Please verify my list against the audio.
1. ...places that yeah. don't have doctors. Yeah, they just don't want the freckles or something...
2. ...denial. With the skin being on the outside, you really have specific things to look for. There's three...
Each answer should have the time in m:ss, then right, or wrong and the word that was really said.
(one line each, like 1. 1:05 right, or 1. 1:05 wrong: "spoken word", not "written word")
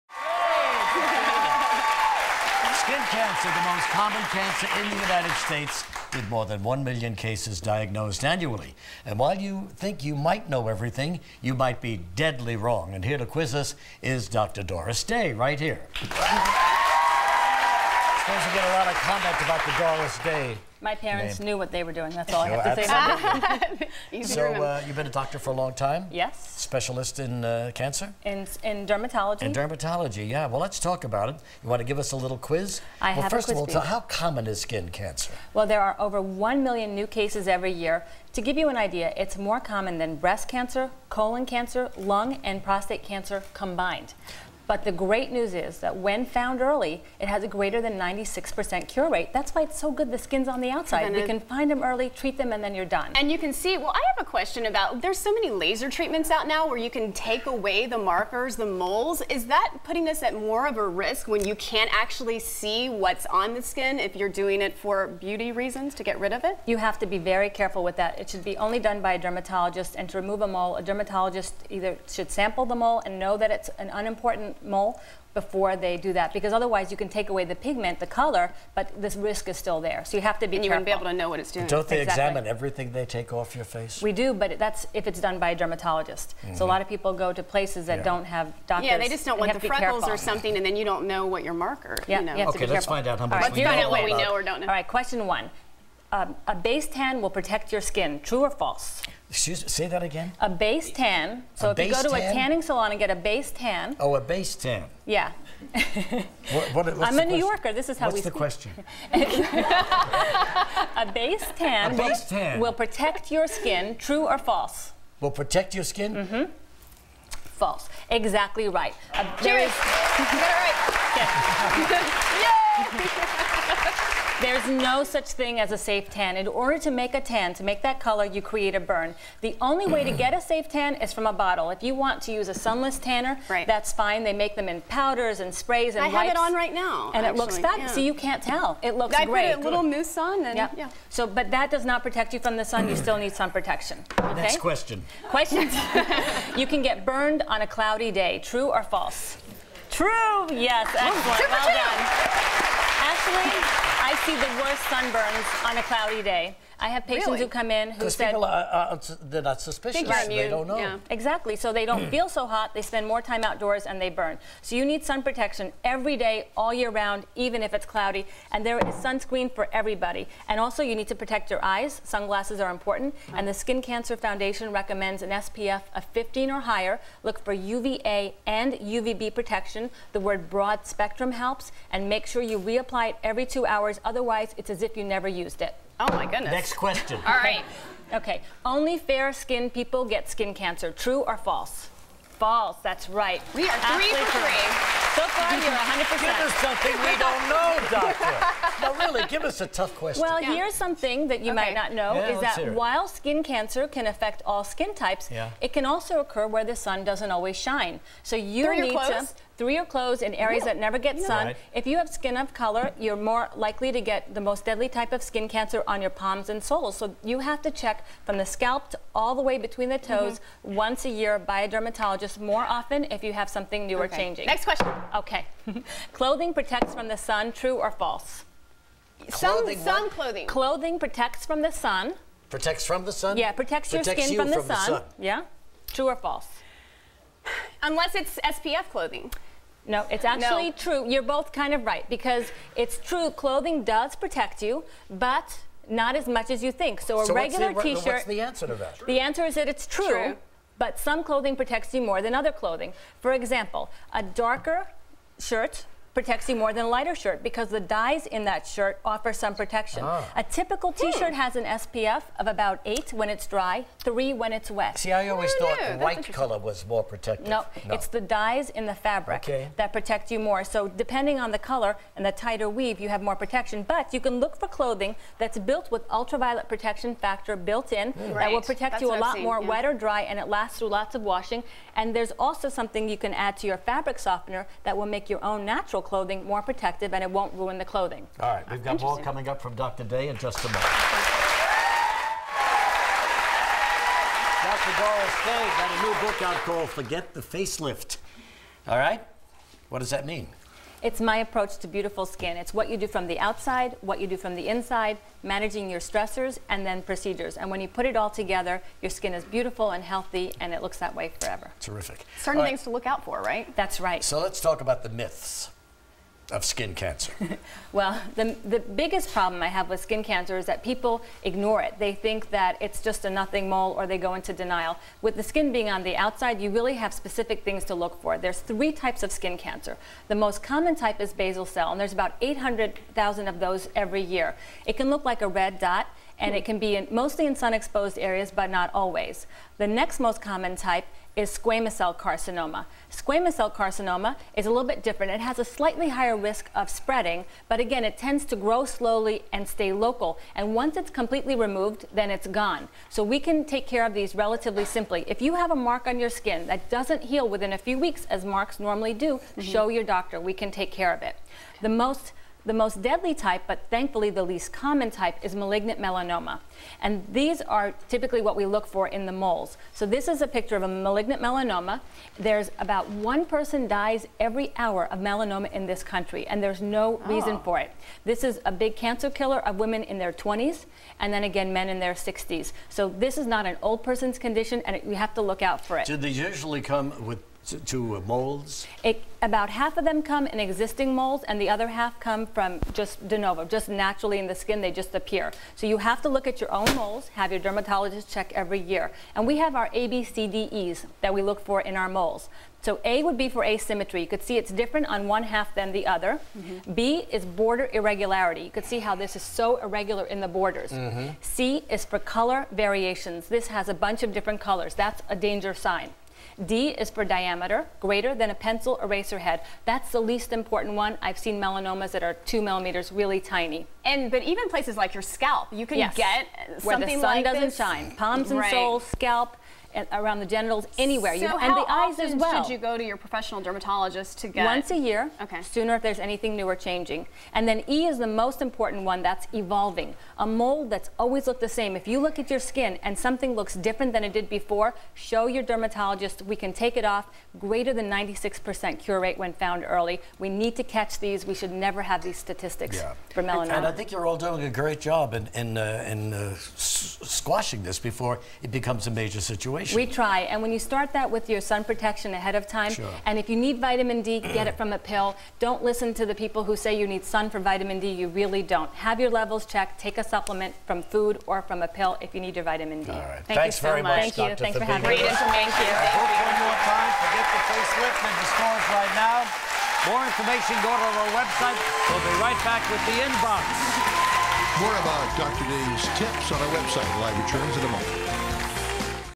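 1. 1:27 right
2. 5:24 right.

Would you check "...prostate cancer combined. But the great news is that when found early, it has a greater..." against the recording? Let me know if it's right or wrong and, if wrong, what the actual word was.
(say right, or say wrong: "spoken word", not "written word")
right.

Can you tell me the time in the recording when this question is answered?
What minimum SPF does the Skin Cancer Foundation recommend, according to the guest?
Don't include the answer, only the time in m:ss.
2:55.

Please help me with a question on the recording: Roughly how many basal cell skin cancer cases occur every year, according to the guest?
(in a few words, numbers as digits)
800,000.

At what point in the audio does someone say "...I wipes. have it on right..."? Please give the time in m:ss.
2:16.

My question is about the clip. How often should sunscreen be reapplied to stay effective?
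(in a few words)
every two hours.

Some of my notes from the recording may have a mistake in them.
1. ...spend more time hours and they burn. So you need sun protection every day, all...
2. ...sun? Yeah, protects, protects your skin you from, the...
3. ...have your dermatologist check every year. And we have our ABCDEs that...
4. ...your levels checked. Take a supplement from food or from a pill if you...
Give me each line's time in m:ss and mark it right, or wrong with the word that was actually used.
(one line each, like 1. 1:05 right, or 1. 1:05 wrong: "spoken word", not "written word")
1. 2:42 wrong: "outdoors", not "hours"
2. 3:53 right
3. 6:37 right
4. 7:49 right.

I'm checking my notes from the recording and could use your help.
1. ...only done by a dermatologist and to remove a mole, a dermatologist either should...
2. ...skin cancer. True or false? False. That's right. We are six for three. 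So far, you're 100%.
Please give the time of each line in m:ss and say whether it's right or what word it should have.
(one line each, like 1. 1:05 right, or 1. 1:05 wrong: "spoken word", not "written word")
1. 1:08 right
2. 3:10 wrong: "three", not "six".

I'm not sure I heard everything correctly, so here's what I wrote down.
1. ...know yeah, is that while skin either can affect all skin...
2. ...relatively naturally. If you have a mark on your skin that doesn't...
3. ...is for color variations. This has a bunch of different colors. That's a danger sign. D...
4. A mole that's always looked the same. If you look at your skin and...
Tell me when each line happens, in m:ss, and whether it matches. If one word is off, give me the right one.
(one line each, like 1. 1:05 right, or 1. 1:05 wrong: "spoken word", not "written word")
1. 3:21 wrong: "cancer", not "either"
2. 5:54 wrong: "simply", not "naturally"
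3. 6:51 right
4. 7:20 right.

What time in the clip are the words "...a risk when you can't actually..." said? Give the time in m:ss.
1:00.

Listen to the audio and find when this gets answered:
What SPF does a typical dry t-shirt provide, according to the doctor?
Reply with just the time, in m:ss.
4:21.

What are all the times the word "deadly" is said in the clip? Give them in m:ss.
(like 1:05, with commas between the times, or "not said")
0:12, 3:34, 6:03.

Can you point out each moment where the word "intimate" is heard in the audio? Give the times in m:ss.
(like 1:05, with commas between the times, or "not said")
not said.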